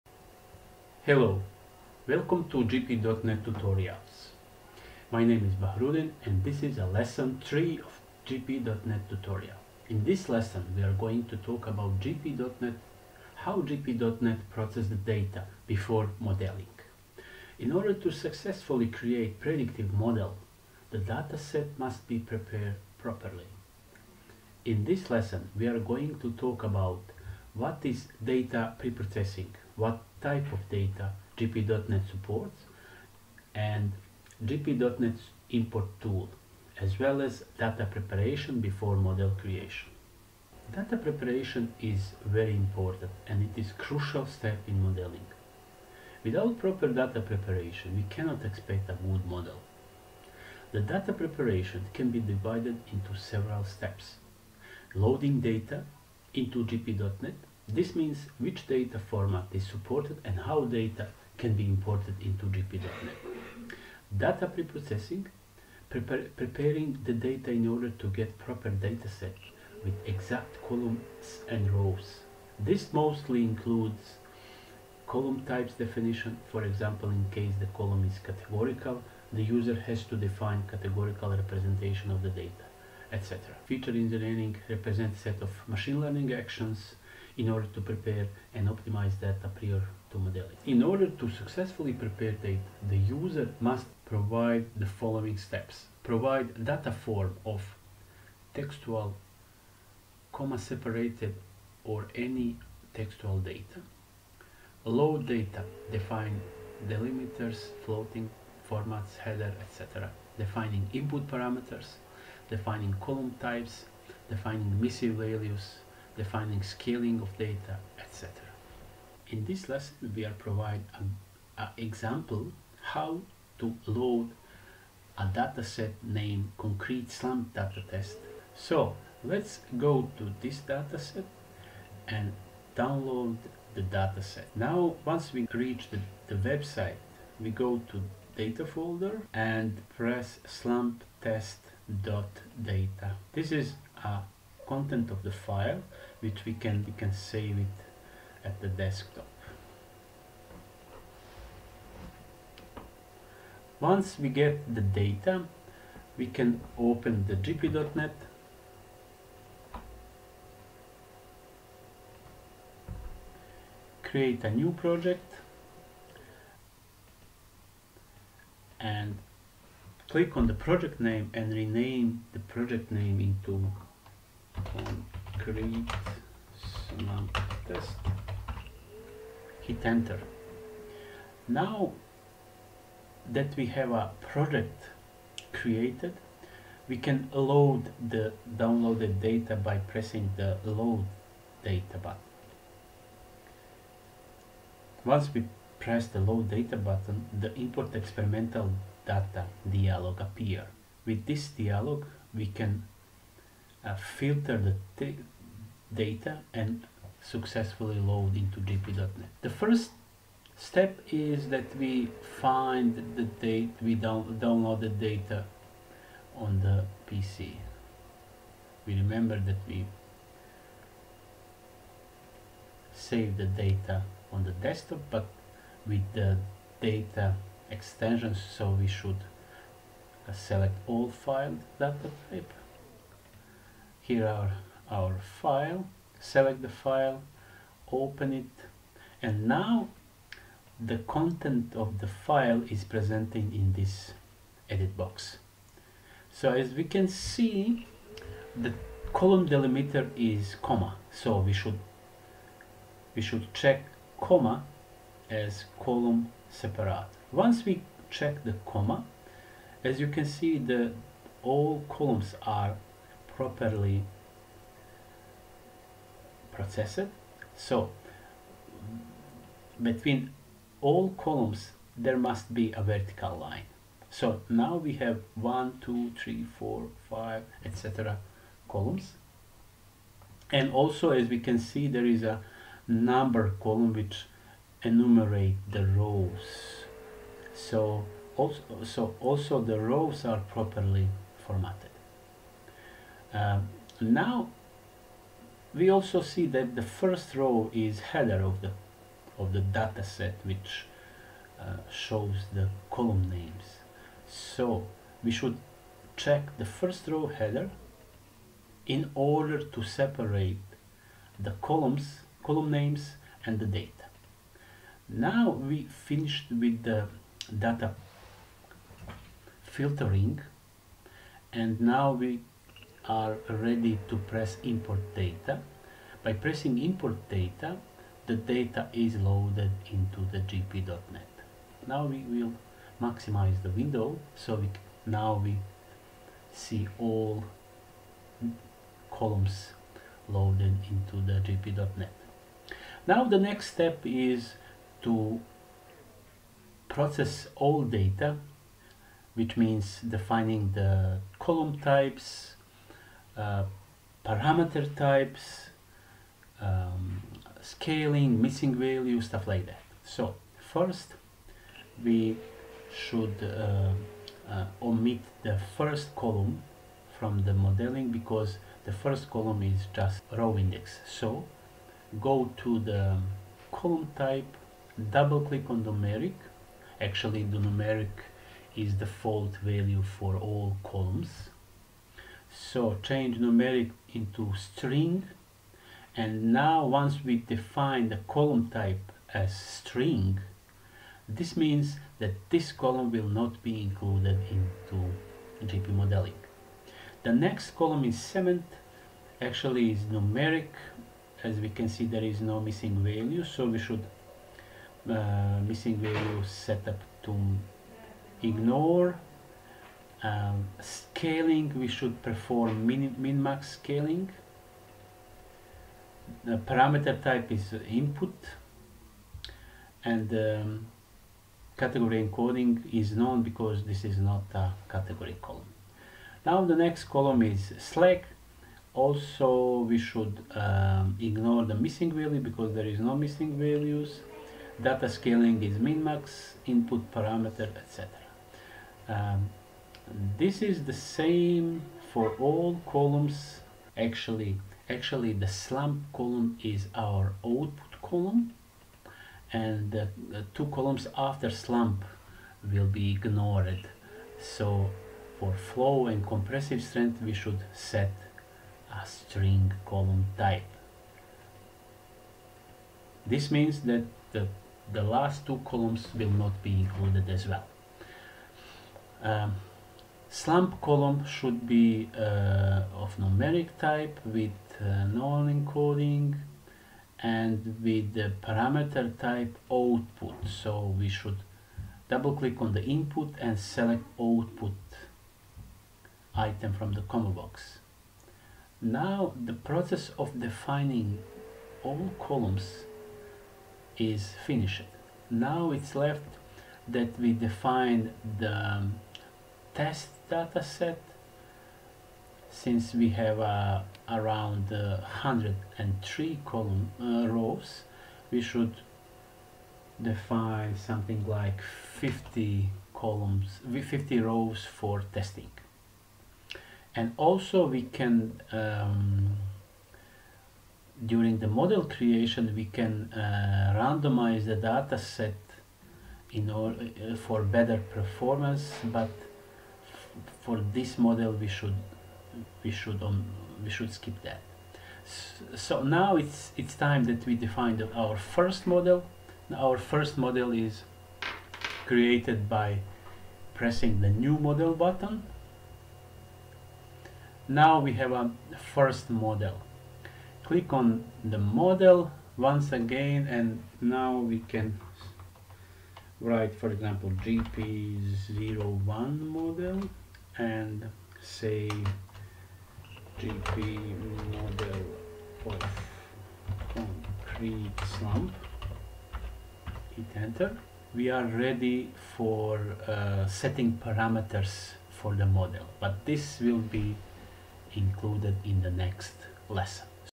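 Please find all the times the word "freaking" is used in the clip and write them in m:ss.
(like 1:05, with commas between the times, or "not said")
not said.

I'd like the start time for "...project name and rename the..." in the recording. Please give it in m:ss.
2:50.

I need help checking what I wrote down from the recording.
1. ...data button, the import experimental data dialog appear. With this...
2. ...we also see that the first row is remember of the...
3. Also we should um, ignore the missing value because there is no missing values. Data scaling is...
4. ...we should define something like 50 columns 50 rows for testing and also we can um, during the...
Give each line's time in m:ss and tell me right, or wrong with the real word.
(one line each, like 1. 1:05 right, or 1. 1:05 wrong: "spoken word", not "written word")
1. 3:16 right
2. 4:55 wrong: "header", not "remember"
3. 7:08 right
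4. 8:28 right.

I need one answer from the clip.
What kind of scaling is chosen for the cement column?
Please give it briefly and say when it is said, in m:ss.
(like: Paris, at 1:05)
min max scaling, at 6:53.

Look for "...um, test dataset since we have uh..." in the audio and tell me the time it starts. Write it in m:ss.
8:18.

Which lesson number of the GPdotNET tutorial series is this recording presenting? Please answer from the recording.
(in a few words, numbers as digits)
3.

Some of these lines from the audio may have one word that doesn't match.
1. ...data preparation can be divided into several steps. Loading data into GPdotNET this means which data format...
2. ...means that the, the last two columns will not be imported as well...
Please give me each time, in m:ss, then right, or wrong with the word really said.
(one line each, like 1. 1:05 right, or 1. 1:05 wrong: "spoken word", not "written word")
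1. 0:50 right
2. 7:43 wrong: "included", not "imported".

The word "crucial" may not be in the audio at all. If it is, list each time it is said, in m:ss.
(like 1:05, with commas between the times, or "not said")
0:43.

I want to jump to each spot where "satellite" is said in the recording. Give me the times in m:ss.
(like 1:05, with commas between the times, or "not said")
not said.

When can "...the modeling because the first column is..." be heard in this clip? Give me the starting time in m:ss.
6:07.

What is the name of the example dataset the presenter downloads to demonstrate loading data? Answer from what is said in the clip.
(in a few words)
concrete slump data test.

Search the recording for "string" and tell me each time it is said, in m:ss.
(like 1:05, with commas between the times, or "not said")
6:24, 6:29, 7:39.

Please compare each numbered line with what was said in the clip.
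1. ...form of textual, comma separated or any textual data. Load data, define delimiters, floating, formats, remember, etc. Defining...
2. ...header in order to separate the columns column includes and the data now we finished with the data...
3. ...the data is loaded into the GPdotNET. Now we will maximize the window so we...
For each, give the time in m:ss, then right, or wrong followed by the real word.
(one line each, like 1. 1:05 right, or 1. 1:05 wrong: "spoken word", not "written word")
1. 1:36 wrong: "header", not "remember"
2. 5:07 wrong: "names", not "includes"
3. 5:28 right.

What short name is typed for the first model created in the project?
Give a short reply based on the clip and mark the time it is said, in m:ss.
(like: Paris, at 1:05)
gp01, at 9:17.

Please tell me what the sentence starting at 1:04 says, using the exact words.
Data preprocessing, prepare, preparing the data in order to get proper dataset with exact columns and rows.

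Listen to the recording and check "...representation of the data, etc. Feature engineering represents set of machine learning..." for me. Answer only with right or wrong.
right.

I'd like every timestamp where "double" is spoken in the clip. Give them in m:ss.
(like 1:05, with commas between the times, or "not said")
6:15, 8:02.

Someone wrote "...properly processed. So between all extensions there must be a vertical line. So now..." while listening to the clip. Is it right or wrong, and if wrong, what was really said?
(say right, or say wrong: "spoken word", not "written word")
wrong: "columns", not "extensions".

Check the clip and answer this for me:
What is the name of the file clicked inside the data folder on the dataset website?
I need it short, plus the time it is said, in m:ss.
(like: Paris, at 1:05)
slump test dot data, at 2:20.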